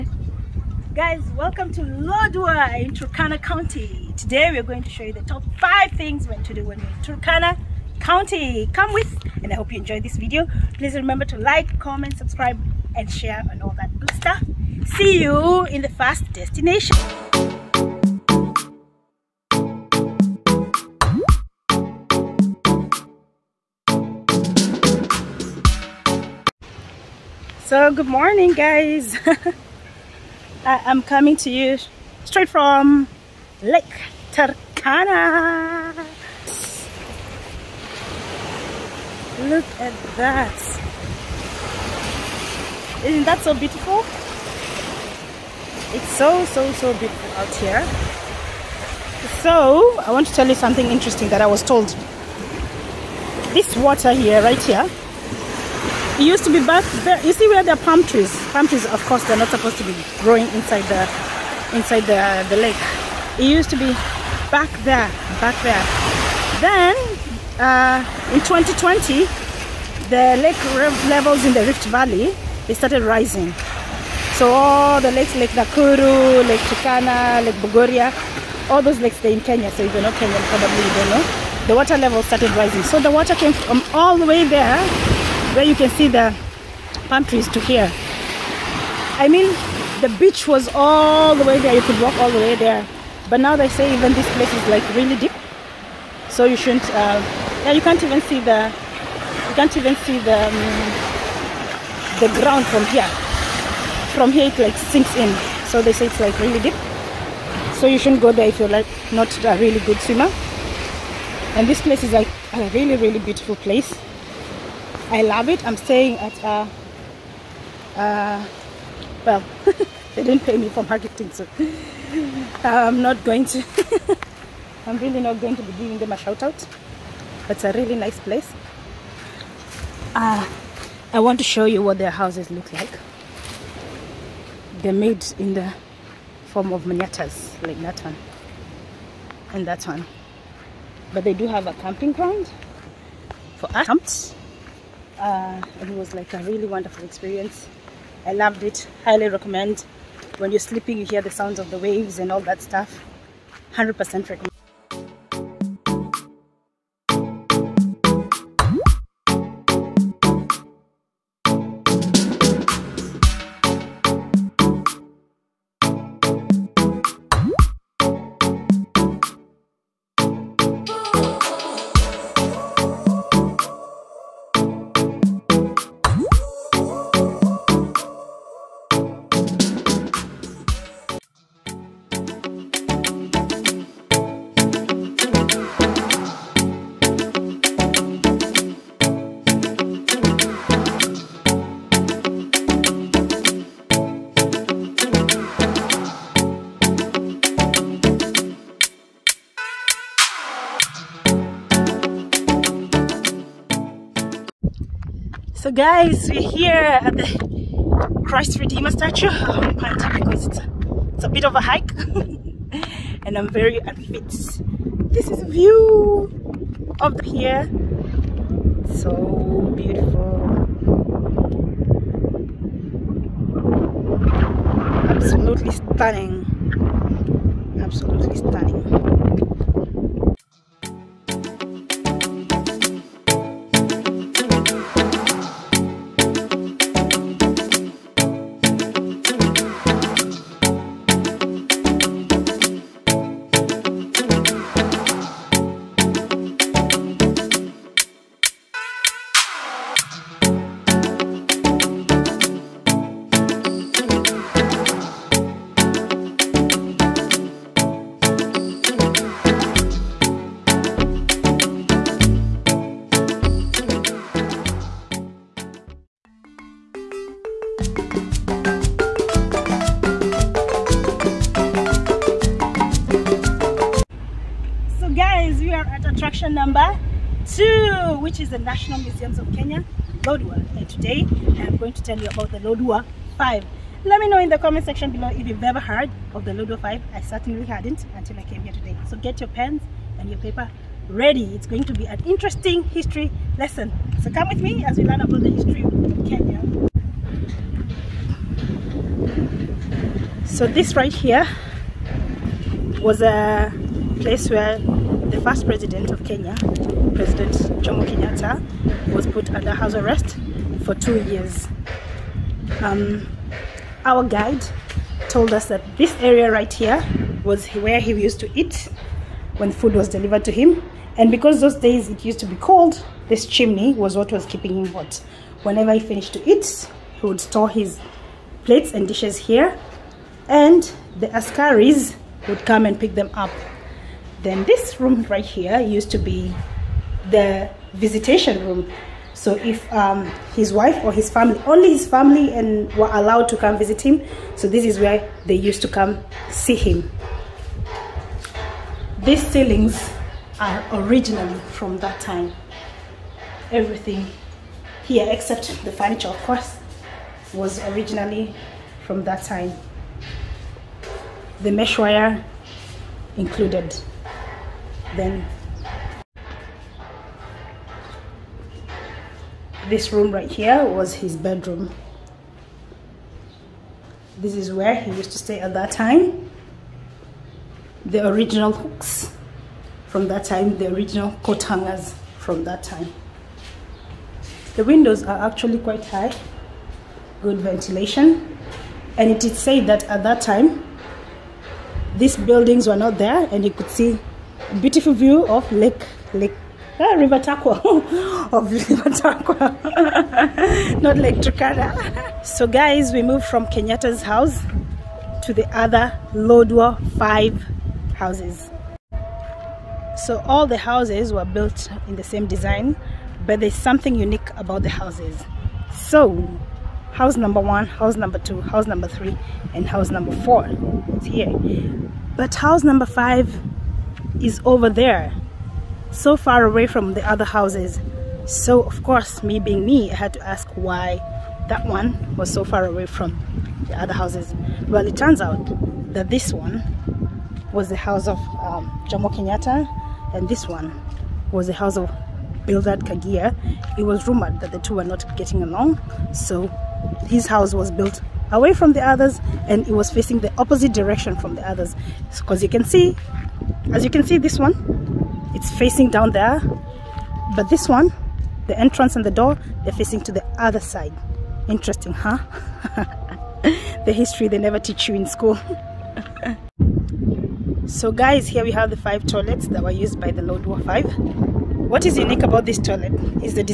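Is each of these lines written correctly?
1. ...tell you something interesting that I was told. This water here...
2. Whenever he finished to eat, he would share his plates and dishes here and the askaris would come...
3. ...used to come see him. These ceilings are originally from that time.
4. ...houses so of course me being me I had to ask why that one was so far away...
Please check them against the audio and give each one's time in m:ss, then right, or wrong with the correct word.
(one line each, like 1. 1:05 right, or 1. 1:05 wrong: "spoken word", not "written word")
1. 0:50 right
2. 5:25 wrong: "store", not "share"
3. 5:45 right
4. 7:07 right.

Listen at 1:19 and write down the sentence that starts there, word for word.
So if you're not Kenyan, probably you don't know.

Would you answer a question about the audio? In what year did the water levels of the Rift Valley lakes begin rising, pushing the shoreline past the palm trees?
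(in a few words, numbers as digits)
2020.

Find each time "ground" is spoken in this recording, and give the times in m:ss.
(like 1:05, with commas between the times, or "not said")
1:42, 2:22.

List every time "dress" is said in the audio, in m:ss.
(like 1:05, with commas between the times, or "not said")
not said.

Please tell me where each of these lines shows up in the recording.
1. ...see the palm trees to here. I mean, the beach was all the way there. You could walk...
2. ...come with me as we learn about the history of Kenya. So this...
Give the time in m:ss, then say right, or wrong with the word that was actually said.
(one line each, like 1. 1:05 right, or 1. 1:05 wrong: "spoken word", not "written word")
1. 1:25 right
2. 4:54 right.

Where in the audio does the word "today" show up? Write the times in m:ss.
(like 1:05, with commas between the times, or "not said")
0:04, 4:40, 4:48.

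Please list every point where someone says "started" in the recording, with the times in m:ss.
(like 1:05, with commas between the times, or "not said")
1:12, 1:22.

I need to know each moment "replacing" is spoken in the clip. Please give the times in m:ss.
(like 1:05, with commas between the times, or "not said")
not said.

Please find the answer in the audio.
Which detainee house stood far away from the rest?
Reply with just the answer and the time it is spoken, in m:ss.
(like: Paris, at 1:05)
5, at 7:02.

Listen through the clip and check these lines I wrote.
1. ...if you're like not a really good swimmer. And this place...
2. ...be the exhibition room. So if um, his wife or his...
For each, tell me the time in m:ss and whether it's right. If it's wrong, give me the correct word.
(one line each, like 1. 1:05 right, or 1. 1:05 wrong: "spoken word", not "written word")
1. 1:48 right
2. 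5:36 wrong: "visitation", not "exhibition".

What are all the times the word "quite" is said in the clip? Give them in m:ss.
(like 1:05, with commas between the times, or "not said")
6:25.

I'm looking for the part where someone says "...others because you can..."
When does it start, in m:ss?
7:31.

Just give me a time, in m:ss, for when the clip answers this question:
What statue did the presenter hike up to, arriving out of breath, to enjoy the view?
3:28.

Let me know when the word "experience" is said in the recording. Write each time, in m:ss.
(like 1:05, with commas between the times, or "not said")
2:27.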